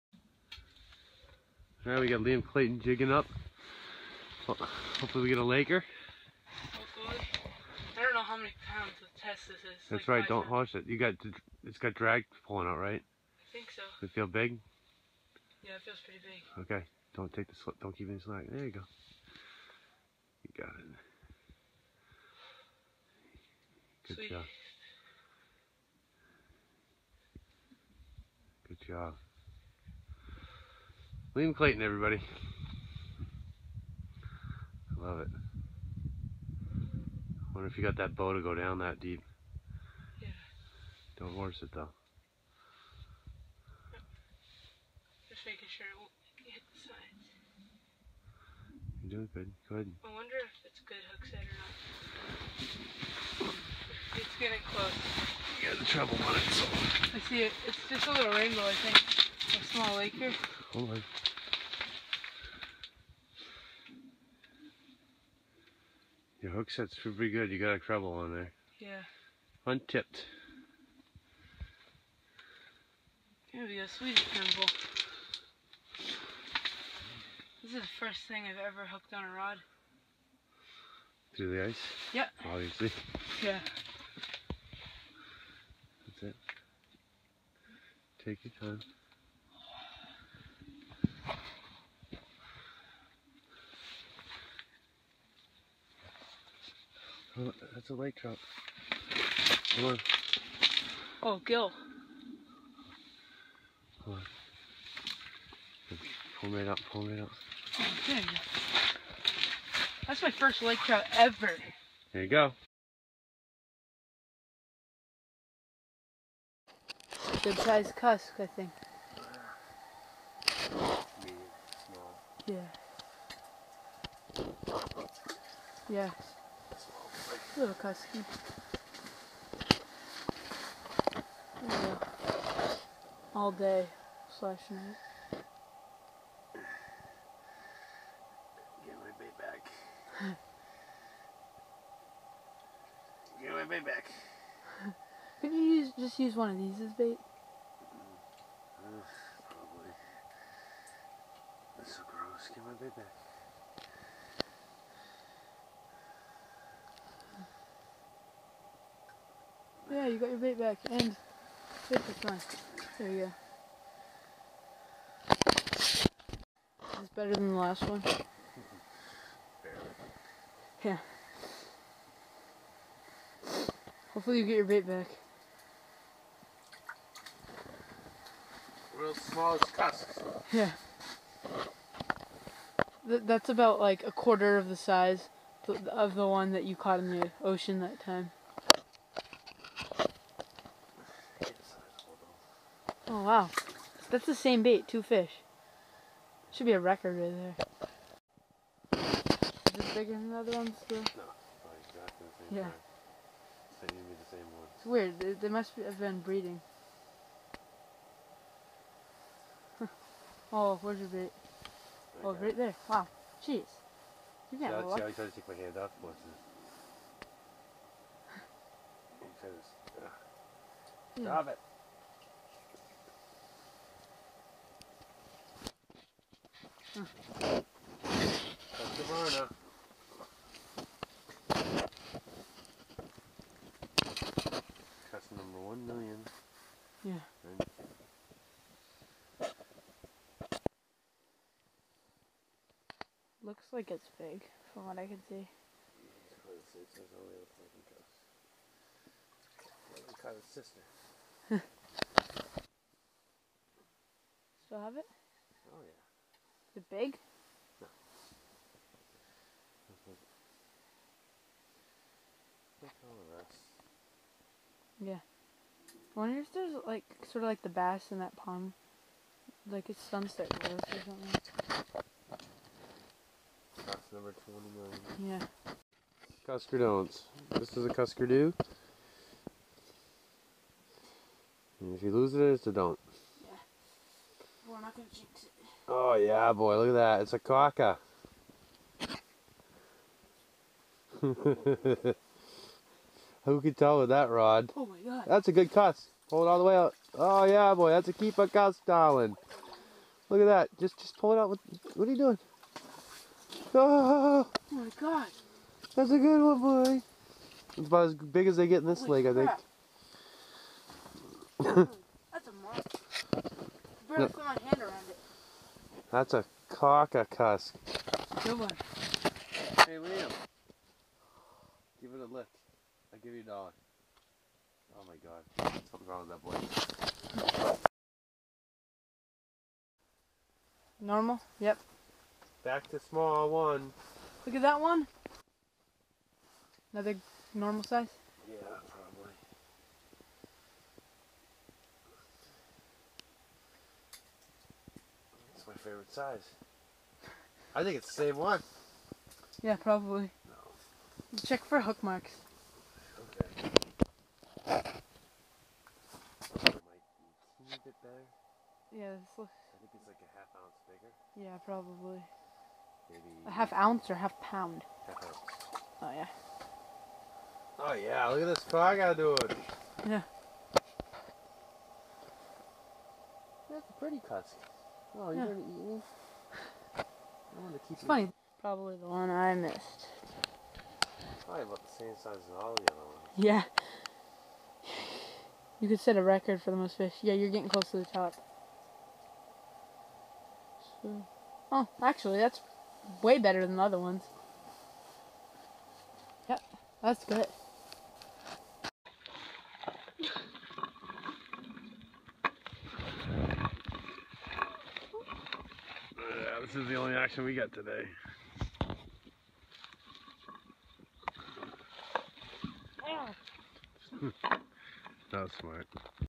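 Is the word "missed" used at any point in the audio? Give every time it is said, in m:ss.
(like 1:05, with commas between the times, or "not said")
6:19.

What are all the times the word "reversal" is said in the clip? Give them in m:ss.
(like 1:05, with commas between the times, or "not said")
not said.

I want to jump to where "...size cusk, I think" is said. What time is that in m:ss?
1:57.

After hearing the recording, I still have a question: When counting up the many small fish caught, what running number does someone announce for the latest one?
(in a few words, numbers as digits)
29.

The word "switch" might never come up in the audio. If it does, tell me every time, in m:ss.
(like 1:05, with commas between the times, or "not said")
not said.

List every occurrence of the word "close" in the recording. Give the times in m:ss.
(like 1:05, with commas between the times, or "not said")
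0:54, 6:27.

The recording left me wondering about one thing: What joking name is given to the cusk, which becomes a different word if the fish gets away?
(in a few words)
cuskerdoo.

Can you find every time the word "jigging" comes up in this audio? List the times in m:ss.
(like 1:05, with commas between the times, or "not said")
0:02.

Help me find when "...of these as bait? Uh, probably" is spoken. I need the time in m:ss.
2:26.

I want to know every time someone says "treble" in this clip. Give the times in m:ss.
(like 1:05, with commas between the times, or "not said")
0:55, 1:07.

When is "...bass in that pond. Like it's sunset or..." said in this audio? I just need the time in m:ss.
4:27.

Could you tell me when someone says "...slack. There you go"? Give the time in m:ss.
0:18.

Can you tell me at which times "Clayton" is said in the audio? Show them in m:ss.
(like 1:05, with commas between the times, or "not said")
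0:02, 0:31.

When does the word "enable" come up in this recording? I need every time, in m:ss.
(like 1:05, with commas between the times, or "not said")
not said.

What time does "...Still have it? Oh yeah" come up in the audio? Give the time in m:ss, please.
4:14.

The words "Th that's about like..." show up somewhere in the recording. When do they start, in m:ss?
3:03.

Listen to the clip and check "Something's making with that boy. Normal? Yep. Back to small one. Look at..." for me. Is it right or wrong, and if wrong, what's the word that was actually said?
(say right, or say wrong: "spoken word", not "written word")
wrong: "wrong", not "making".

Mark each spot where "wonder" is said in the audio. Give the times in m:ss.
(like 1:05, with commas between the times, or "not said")
0:37, 0:50, 4:26.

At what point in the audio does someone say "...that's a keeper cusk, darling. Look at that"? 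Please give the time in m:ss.
4:57.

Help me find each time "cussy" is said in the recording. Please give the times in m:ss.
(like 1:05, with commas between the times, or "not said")
6:14.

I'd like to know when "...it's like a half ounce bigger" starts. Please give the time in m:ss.
5:59.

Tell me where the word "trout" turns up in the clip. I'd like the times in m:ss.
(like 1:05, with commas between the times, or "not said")
1:38, 1:50.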